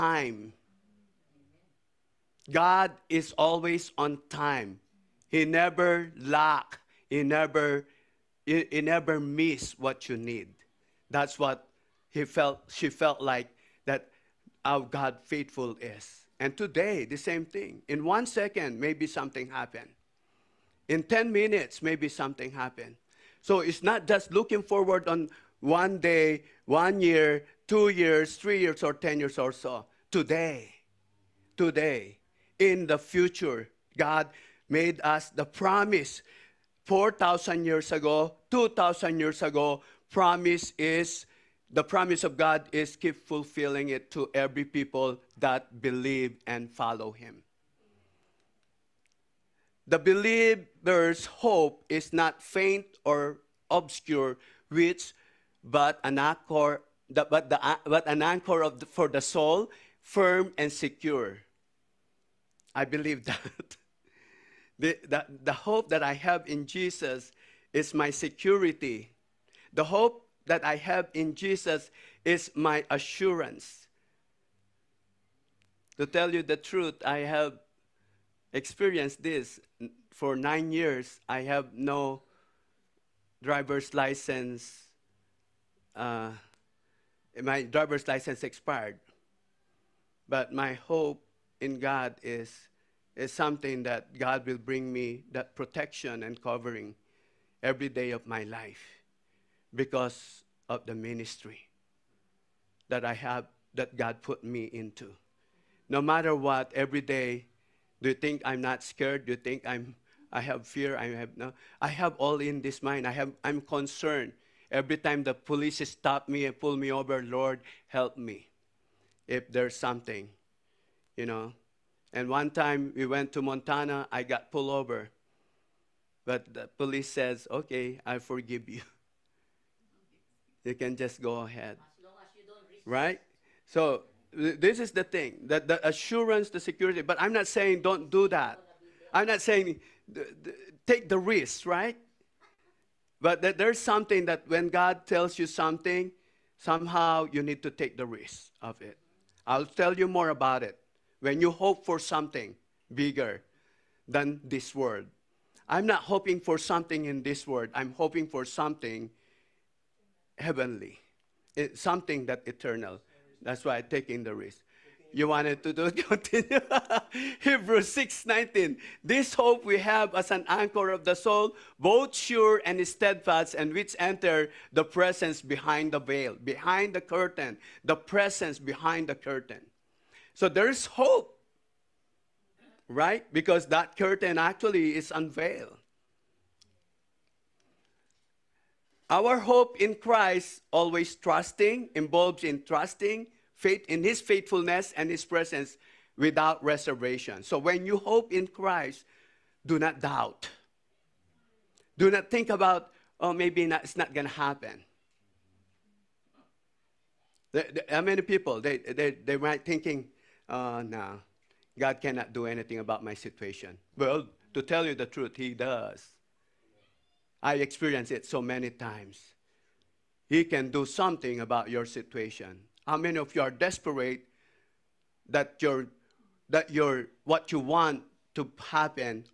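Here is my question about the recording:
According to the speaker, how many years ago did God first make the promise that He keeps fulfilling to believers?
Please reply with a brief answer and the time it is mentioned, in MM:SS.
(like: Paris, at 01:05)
4,000 years, at 00:36.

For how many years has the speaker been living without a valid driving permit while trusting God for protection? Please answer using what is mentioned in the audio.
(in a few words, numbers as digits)
9.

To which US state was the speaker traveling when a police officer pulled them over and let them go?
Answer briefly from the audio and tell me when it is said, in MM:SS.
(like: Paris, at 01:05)
Montana, at 02:03.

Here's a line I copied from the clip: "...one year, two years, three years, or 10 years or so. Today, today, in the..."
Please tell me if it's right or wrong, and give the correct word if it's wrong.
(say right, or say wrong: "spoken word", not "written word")
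right.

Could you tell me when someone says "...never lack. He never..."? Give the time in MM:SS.
00:05.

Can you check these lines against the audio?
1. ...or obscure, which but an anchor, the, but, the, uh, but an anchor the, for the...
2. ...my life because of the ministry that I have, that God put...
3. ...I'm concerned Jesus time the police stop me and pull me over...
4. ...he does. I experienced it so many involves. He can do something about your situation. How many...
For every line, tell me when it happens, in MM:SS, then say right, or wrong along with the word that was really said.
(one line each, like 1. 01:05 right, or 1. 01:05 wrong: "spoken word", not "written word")
1. 00:53 right
2. 01:38 right
3. 01:53 wrong: "Every", not "Jesus"
4. 03:35 wrong: "times", not "involves".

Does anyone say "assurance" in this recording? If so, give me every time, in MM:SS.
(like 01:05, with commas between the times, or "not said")
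01:12, 02:15.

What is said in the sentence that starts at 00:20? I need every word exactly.
In 10 minutes, maybe something happened.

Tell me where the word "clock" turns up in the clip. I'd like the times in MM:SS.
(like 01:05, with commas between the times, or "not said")
not said.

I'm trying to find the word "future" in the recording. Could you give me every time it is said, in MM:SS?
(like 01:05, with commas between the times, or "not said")
00:32.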